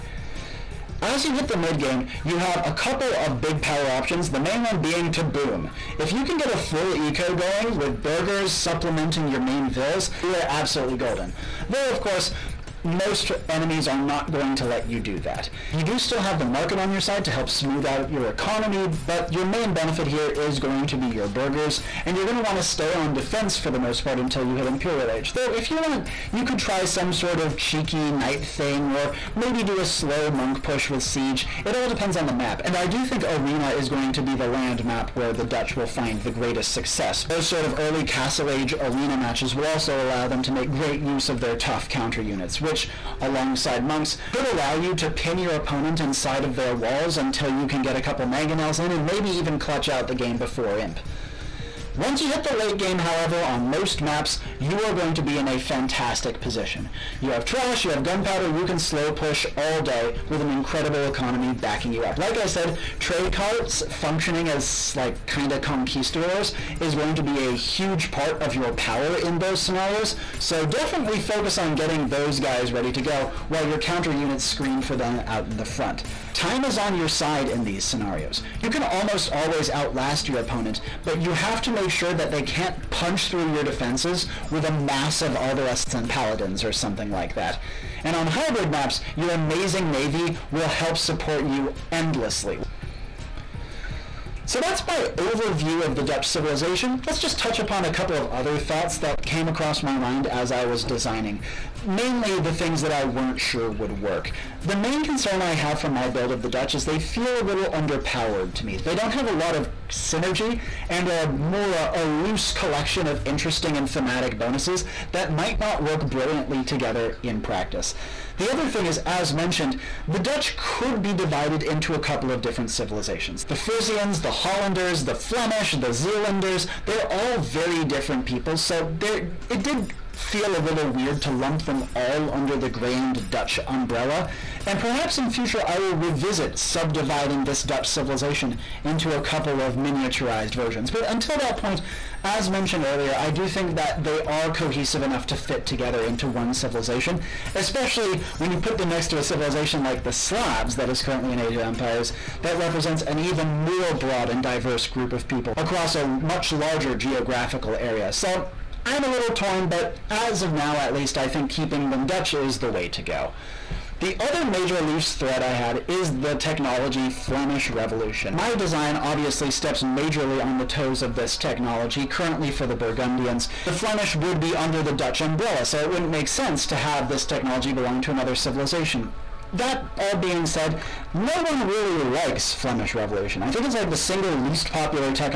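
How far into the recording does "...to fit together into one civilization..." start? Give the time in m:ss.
2:25.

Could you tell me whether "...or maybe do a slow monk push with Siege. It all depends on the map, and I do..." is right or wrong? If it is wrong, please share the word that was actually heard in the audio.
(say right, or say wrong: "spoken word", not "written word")
right.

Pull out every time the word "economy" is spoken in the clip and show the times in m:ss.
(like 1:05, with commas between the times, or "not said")
0:18, 1:01.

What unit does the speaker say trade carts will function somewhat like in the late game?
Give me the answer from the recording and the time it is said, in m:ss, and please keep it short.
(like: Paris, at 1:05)
conquistadors, at 1:05.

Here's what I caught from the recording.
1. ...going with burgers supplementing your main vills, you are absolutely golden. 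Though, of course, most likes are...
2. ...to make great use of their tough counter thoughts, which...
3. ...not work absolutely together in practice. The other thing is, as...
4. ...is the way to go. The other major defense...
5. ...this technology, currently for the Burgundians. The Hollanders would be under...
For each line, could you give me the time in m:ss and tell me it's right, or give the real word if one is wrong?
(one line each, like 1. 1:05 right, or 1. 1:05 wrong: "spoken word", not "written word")
1. 0:07 wrong: "enemies", not "likes"
2. 0:40 wrong: "units", not "thoughts"
3. 1:55 wrong: "brilliantly", not "absolutely"
4. 2:42 wrong: "loose", not "defense"
5. 2:51 wrong: "Flemish", not "Hollanders".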